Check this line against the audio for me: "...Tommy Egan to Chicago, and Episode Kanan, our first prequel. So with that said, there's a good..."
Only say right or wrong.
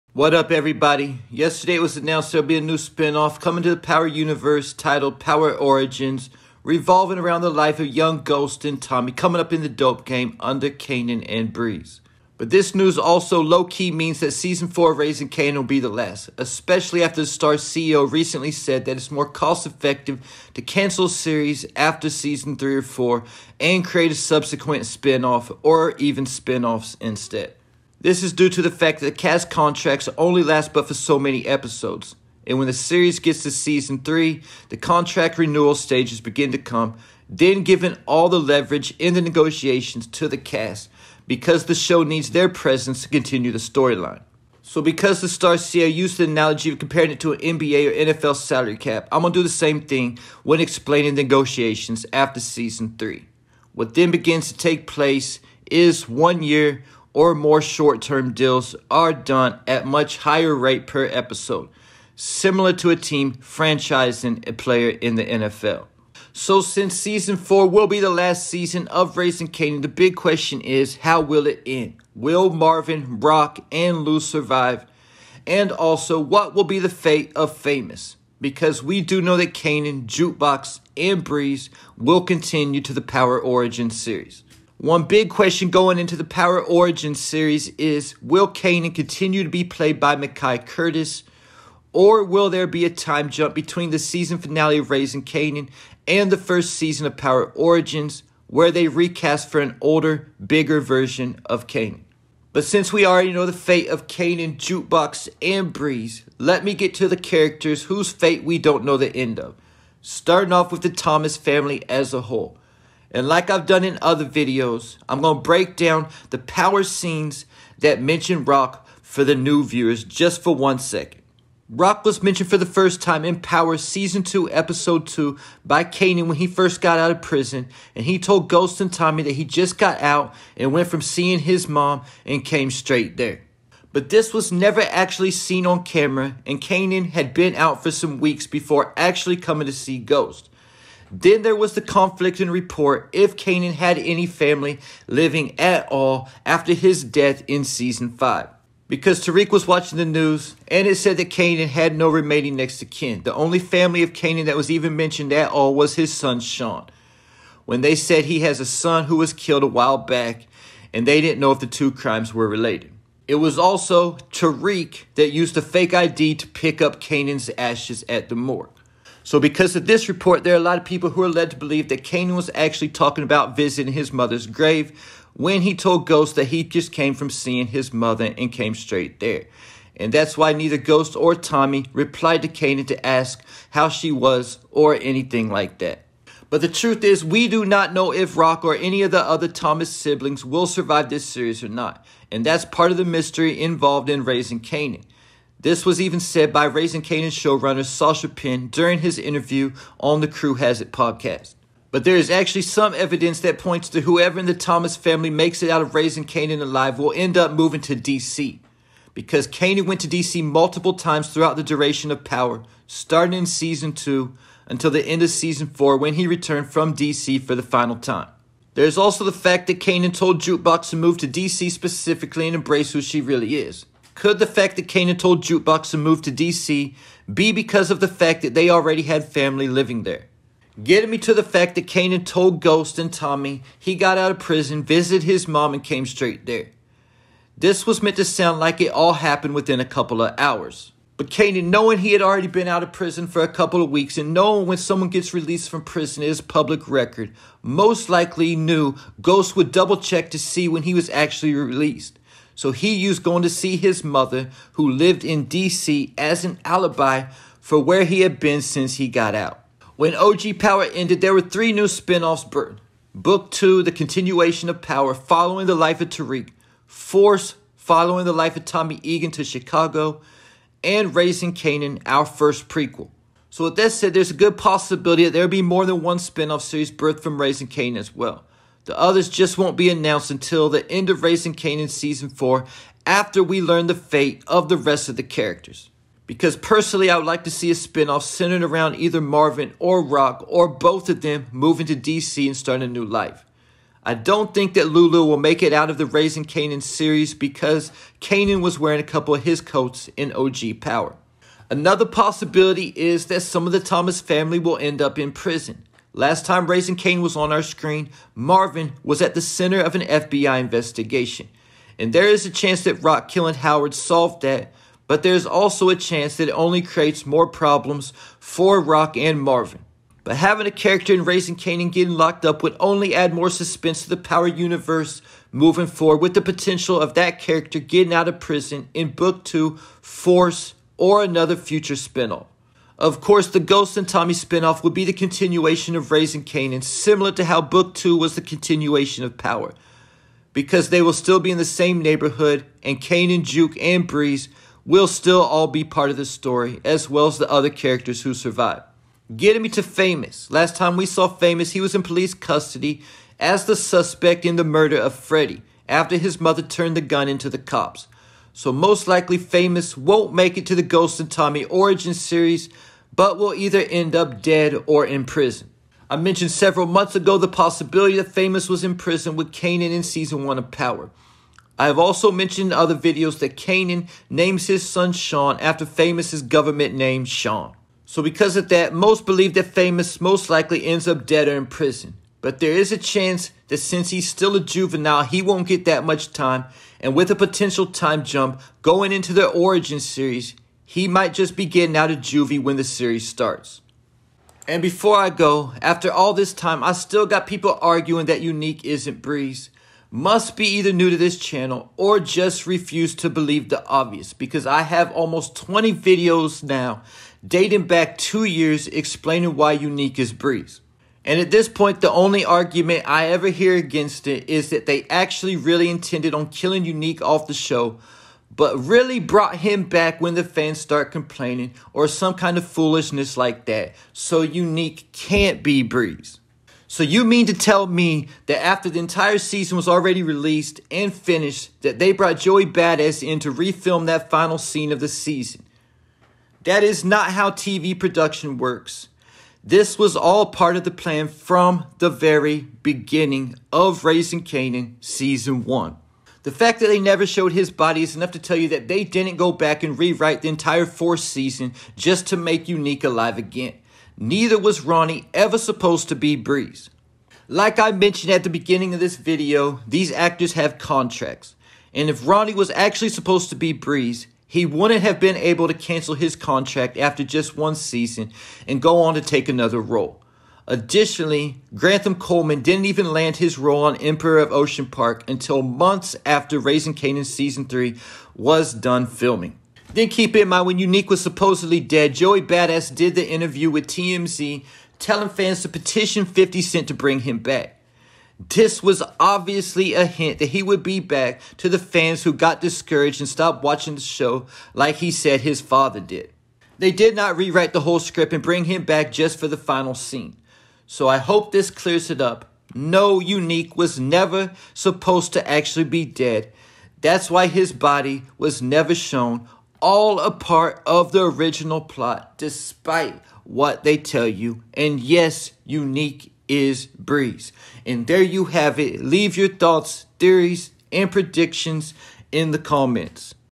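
wrong.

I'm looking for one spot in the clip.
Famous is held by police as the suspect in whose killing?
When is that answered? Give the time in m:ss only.
5:55.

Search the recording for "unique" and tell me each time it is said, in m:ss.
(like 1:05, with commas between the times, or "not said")
6:38, 6:49, 6:56, 7:04, 7:32, 8:00, 8:23, 8:35.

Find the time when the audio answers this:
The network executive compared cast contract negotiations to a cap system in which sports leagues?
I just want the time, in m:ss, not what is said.
0:47.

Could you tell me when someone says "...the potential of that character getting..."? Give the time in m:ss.
5:26.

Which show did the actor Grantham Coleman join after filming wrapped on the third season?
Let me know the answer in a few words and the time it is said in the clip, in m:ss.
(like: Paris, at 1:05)
Emperor of Ocean Park, at 7:53.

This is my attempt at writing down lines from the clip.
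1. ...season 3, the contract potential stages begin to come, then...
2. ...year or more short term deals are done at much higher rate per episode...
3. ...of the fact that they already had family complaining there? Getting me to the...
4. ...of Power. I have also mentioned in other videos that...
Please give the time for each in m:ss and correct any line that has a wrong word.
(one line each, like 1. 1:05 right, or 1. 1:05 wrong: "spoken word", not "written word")
1. 0:33 wrong: "renewal", not "potential"
2. 0:56 right
3. 3:47 wrong: "living", not "complaining"
4. 6:10 right.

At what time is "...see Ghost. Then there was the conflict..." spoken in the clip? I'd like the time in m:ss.
2:19.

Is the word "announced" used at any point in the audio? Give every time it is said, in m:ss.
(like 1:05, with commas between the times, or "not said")
0:01, 4:39.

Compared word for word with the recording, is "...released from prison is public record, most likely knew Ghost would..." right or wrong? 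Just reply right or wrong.
right.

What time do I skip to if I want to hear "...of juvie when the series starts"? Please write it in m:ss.
6:32.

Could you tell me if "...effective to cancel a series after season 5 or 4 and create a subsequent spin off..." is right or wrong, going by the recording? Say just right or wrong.
wrong.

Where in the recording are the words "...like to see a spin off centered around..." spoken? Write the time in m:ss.
4:47.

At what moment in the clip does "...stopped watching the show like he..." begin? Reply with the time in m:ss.
8:13.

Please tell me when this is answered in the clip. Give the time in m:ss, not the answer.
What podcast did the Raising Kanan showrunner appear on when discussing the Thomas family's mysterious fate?
3:20.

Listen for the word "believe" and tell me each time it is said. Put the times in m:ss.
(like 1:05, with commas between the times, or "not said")
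2:51, 6:19, 6:43.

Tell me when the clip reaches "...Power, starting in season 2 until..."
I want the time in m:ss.
3:32.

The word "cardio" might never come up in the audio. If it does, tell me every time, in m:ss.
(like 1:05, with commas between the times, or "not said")
not said.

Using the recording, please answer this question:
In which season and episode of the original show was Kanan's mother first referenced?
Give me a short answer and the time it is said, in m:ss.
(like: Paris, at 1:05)
Season 2, Episode 2, at 2:03.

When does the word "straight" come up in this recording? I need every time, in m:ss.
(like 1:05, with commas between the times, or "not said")
2:12, 2:58, 3:56.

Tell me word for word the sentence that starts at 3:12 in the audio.
And that's part of the mystery involved in raising Kanan.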